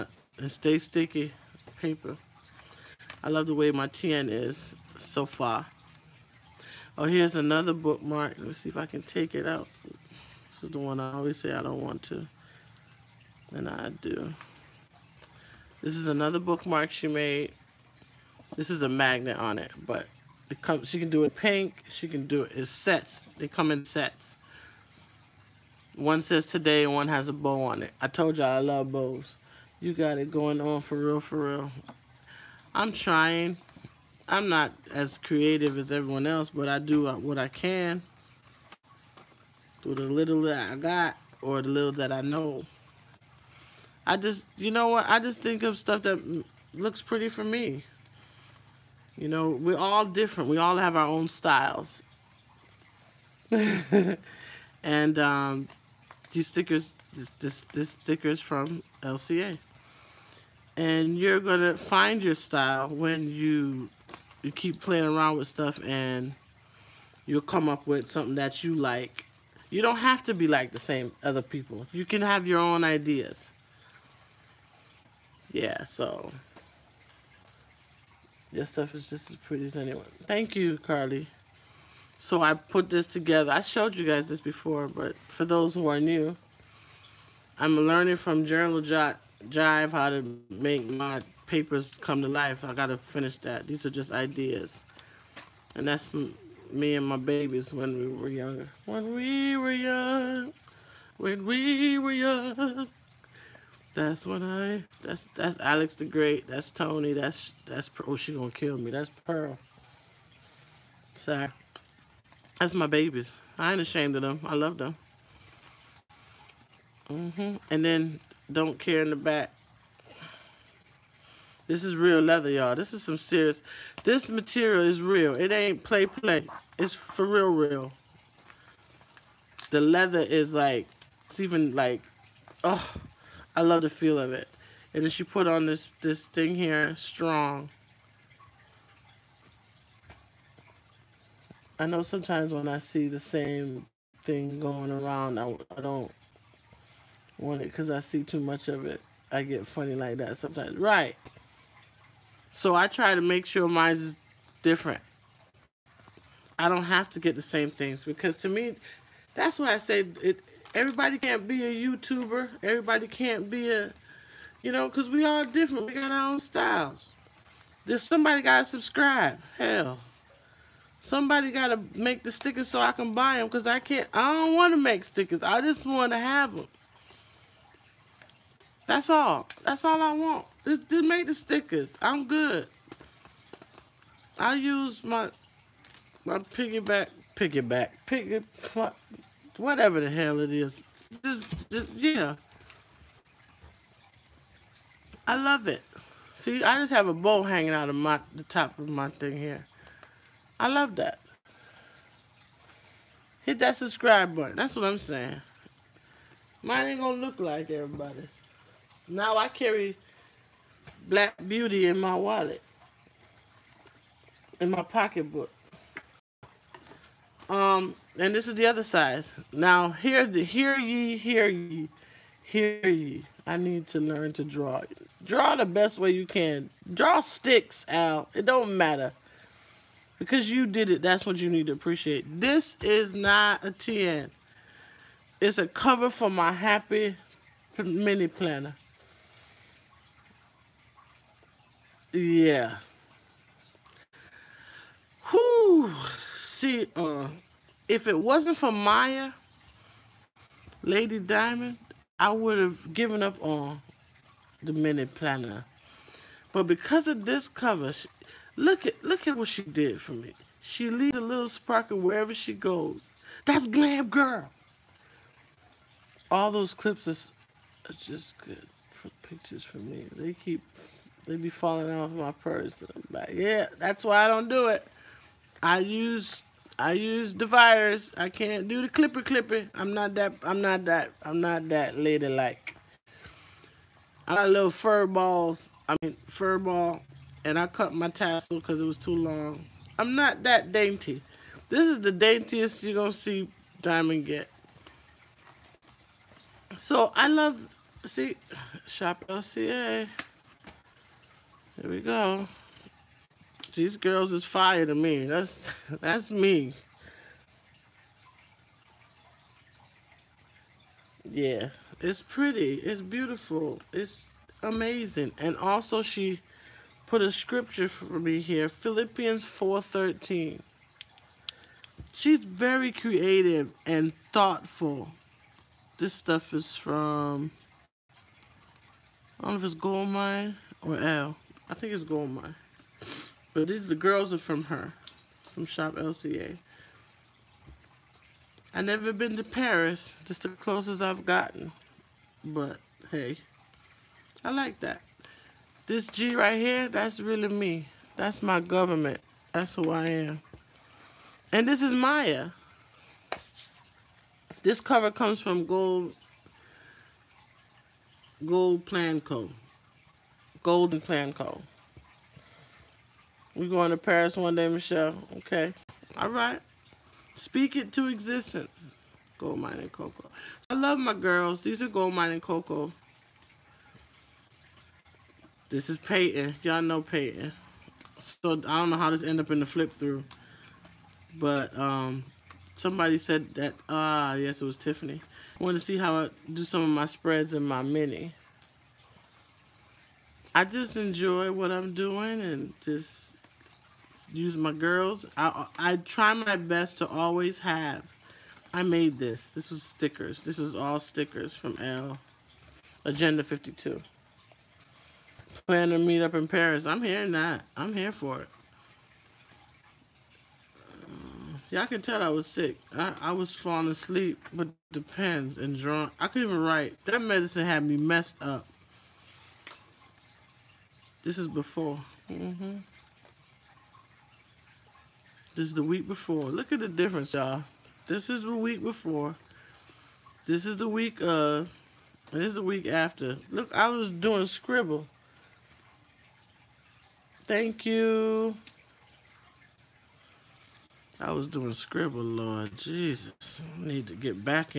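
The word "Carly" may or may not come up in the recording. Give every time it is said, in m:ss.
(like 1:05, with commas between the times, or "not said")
1:20.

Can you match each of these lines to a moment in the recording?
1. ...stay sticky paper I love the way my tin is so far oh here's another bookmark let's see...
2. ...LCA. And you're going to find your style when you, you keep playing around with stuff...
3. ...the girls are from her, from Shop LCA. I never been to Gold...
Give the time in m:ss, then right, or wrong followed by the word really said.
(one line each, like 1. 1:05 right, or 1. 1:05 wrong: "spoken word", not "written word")
1. 0:00 right
2. 0:59 right
3. 5:33 wrong: "Paris", not "Gold".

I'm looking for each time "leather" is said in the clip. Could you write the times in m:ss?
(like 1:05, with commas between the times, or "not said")
2:02, 2:09.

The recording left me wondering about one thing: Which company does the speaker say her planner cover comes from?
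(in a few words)
Golden Plan Co.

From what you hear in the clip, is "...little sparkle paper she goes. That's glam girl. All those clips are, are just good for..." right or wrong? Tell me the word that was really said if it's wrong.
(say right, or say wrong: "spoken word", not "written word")
wrong: "wherever", not "paper".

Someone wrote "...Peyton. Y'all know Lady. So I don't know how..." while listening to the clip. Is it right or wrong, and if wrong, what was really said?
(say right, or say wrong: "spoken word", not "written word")
wrong: "Peyton", not "Lady".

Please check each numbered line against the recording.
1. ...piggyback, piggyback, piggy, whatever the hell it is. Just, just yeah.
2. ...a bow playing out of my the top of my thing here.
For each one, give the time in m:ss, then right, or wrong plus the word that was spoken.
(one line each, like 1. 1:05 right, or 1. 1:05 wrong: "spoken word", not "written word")
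1. 3:06 right
2. 3:17 wrong: "hanging", not "playing".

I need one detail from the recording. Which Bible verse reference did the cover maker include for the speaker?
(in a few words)
Philippians 4:13.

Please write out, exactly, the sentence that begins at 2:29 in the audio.
I get funny like that sometimes.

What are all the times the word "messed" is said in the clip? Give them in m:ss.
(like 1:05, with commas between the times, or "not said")
6:57.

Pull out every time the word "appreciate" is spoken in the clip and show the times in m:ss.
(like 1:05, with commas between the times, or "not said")
3:51.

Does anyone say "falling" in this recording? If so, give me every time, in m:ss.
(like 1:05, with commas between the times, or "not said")
4:31, 6:53.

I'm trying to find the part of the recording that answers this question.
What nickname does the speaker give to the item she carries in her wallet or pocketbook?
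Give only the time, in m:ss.
3:31.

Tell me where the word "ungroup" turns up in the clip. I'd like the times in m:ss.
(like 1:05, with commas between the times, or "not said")
not said.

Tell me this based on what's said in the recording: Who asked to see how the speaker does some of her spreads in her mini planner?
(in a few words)
Tiffany.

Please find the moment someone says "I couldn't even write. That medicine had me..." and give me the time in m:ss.
6:56.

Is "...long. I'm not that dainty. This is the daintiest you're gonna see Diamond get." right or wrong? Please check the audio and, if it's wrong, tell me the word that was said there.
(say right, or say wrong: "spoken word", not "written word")
right.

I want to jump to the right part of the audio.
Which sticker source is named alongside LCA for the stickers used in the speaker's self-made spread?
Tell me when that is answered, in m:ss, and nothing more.
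6:43.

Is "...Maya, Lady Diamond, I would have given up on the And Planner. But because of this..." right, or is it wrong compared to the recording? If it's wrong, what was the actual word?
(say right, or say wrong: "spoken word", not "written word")
wrong: "Minute", not "And".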